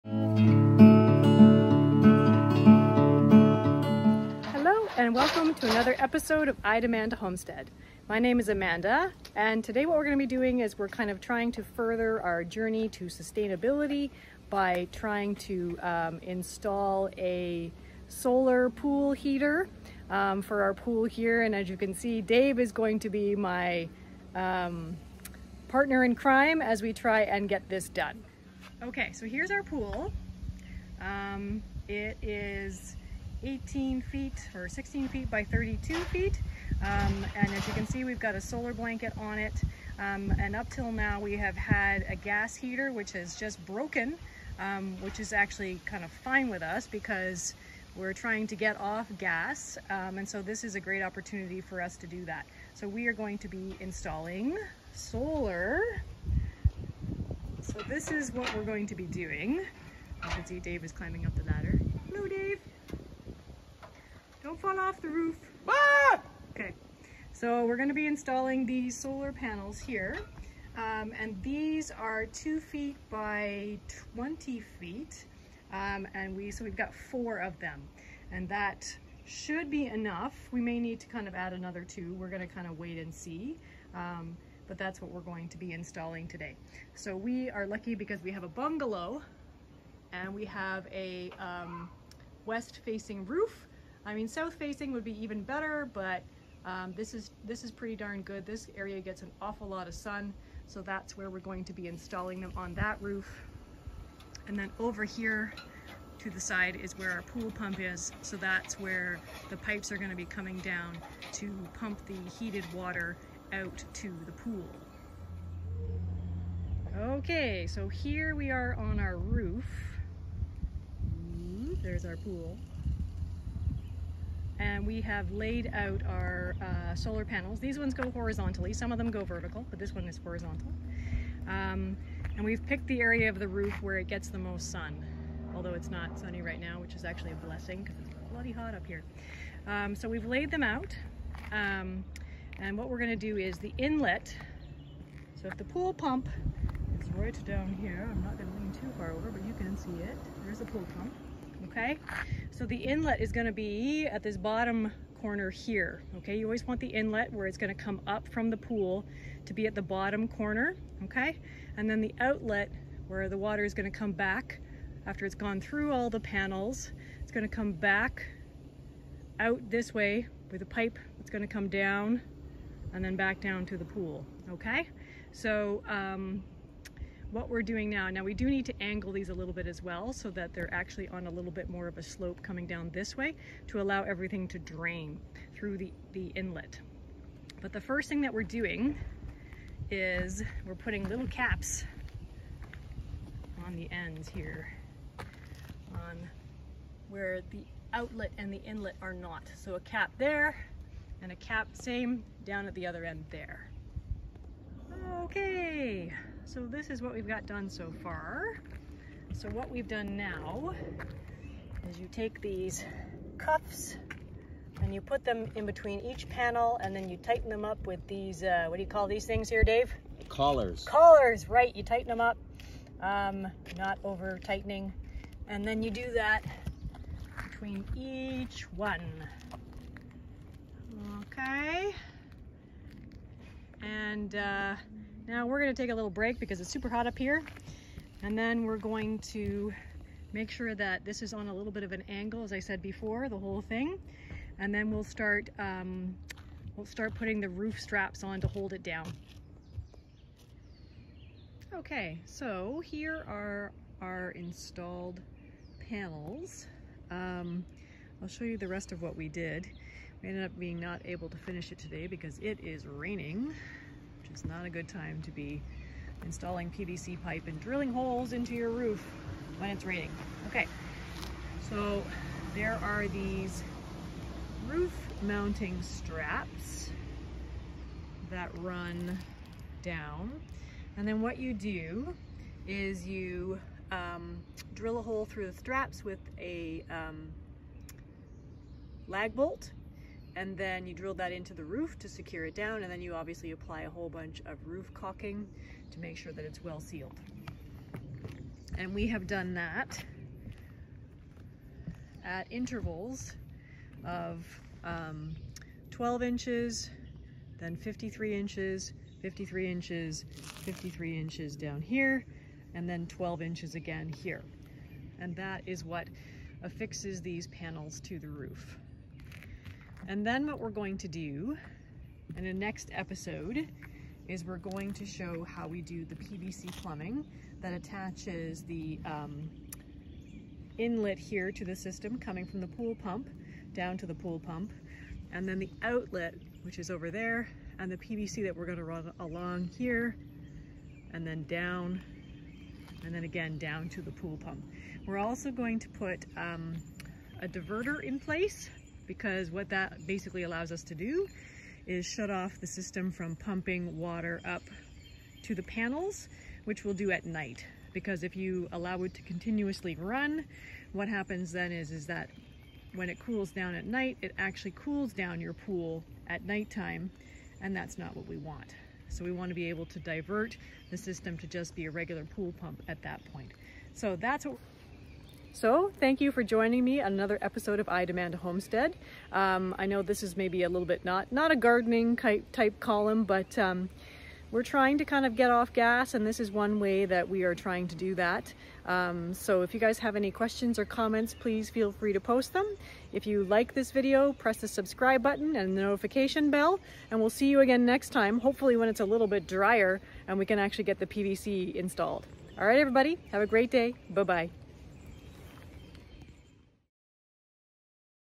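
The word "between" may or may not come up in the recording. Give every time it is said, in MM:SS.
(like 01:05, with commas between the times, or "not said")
03:35, 03:47.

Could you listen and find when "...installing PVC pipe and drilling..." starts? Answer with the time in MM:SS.
04:26.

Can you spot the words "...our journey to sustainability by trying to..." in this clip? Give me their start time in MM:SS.
00:12.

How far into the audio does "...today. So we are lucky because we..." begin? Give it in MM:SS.
01:26.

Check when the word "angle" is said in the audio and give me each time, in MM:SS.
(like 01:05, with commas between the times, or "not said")
02:58, 04:02.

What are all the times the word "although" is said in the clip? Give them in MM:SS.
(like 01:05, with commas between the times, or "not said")
02:15.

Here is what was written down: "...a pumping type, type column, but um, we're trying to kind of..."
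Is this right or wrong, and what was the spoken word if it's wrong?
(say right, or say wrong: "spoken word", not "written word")
wrong: "gardening", not "pumping".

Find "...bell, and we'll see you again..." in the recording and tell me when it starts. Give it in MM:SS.
06:36.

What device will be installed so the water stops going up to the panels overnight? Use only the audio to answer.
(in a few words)
A diverter.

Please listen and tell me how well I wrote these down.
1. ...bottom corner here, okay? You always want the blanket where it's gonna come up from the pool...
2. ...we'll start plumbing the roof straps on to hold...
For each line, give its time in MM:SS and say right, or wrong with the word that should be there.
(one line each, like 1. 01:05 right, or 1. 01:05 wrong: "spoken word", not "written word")
1. 02:34 wrong: "inlet", not "blanket"
2. 04:06 wrong: "putting", not "plumbing".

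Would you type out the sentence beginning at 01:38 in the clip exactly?
This area gets an awful lot of sun, so that's where we're going to be installing them on that roof.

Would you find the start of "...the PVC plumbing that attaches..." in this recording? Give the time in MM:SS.
05:26.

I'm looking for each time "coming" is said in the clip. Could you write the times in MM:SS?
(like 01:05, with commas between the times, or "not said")
01:50, 03:02, 05:32.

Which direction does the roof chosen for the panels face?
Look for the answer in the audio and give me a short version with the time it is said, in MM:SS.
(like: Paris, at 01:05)
West, at 01:32.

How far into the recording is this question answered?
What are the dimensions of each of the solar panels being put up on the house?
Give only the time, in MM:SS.
01:12.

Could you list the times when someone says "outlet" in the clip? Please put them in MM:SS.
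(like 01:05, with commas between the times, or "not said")
02:42, 03:17, 05:35.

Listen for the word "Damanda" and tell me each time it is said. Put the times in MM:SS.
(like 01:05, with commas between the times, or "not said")
00:06, 06:18.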